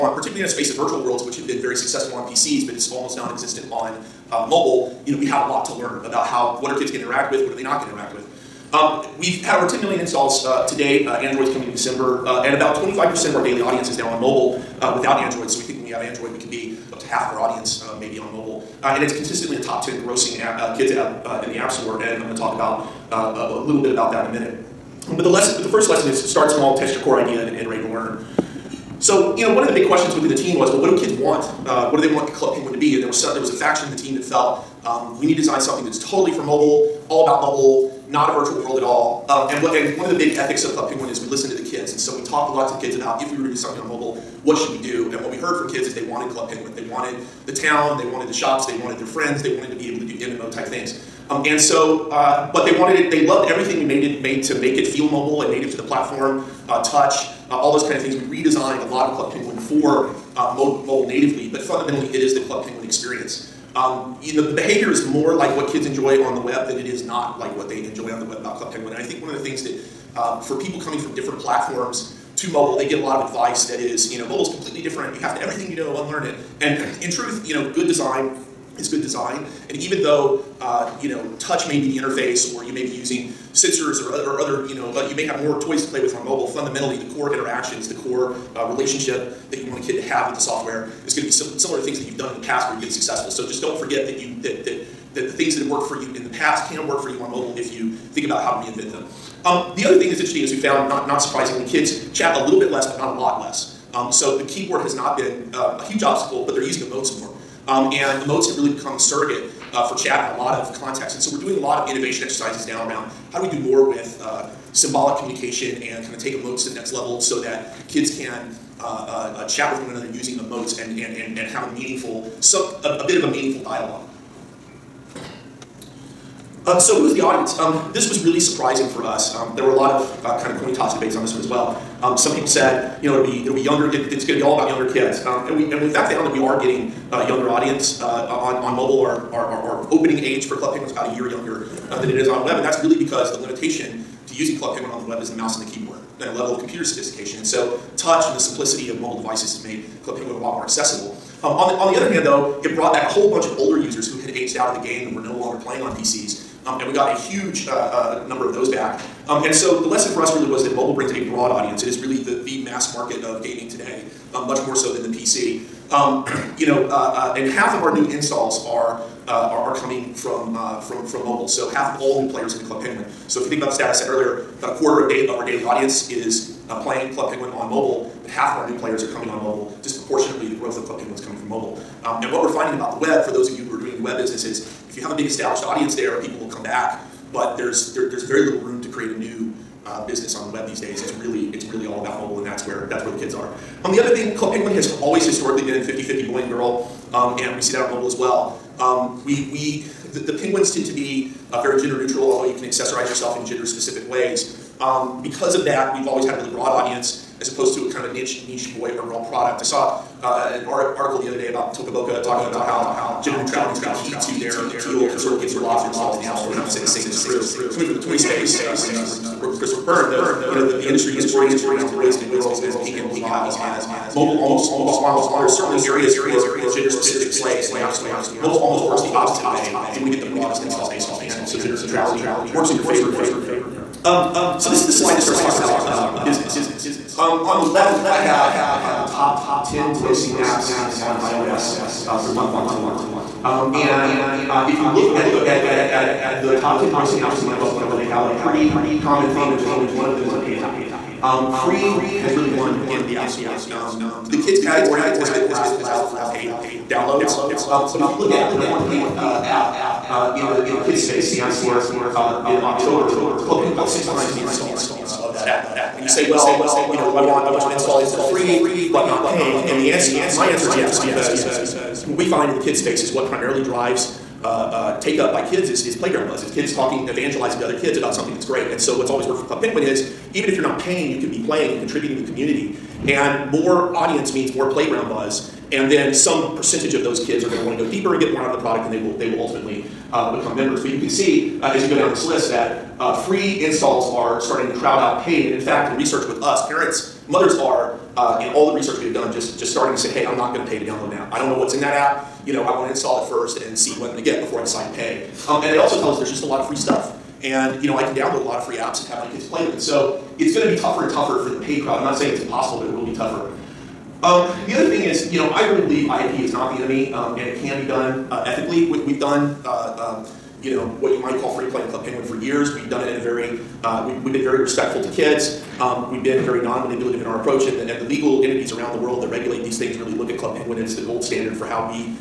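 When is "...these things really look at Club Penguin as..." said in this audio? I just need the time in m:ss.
5:29.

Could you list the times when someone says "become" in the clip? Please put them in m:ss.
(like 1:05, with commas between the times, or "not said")
1:48, 4:50.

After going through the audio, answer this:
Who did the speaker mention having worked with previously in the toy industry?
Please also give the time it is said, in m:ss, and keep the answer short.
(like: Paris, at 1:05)
Christopher Byrne, at 3:39.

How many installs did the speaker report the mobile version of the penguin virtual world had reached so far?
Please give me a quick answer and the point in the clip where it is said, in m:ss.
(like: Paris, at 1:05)
Over 10 million, at 0:09.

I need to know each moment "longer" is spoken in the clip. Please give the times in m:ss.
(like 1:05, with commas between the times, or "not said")
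2:35.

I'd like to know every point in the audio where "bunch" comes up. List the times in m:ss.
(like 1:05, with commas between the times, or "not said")
2:33, 4:27.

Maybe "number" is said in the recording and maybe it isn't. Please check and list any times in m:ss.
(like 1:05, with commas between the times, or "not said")
2:38, 4:18.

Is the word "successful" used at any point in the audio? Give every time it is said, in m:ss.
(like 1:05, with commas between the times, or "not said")
0:01, 1:32.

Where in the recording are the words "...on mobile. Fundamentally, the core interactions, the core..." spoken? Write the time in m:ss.
1:26.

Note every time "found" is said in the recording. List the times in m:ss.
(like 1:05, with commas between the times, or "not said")
1:40, 2:16.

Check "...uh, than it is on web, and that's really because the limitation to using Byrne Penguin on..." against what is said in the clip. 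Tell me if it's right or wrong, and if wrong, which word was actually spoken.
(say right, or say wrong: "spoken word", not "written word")
wrong: "Club", not "Byrne".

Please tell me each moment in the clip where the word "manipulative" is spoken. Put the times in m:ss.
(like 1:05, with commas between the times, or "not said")
5:26.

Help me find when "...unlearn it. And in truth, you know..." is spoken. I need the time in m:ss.
1:16.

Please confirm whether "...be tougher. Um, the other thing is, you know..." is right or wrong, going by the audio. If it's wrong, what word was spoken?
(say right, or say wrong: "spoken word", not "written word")
right.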